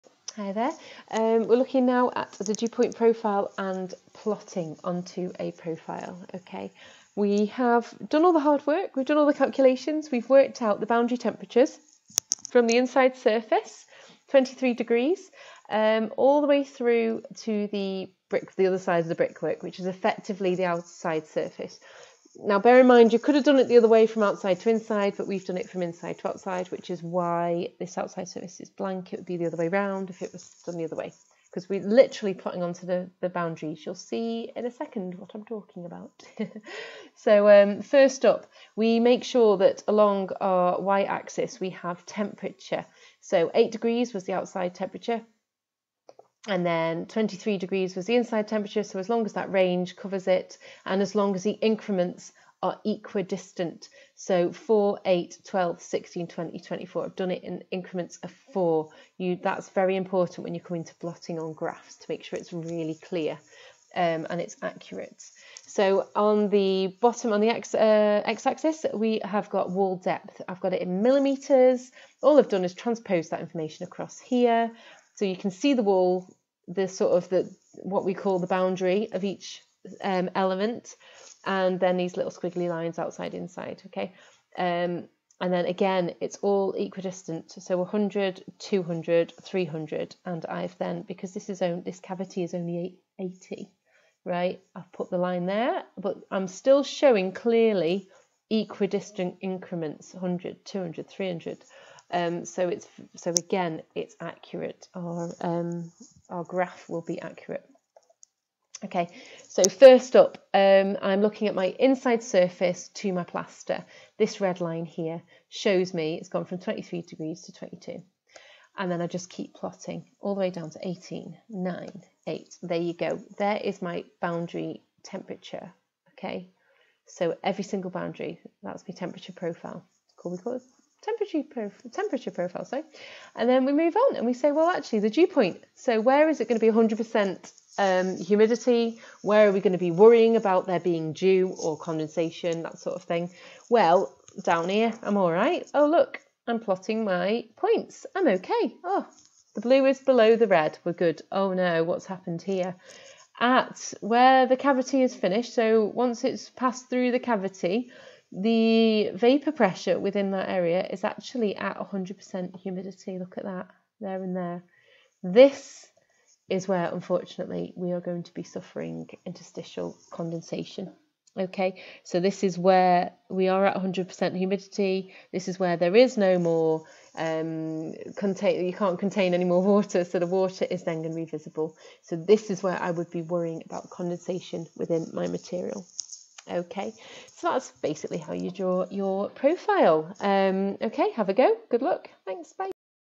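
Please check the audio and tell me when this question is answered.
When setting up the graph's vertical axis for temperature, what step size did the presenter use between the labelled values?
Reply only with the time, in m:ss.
0:57.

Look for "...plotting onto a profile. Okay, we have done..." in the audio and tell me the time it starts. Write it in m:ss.
0:04.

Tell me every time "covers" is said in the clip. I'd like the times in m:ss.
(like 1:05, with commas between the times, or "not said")
0:49.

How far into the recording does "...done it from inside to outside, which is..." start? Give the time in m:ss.
0:25.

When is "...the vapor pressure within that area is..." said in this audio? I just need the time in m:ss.
2:38.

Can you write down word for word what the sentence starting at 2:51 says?
Okay, so this is where we are at 100% humidity.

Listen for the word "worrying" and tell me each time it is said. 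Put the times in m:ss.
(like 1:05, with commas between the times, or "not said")
2:19, 3:03.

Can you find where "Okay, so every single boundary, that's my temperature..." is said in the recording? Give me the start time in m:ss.
2:06.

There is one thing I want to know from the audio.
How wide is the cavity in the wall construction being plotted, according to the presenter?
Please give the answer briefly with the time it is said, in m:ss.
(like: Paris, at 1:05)
80, at 1:33.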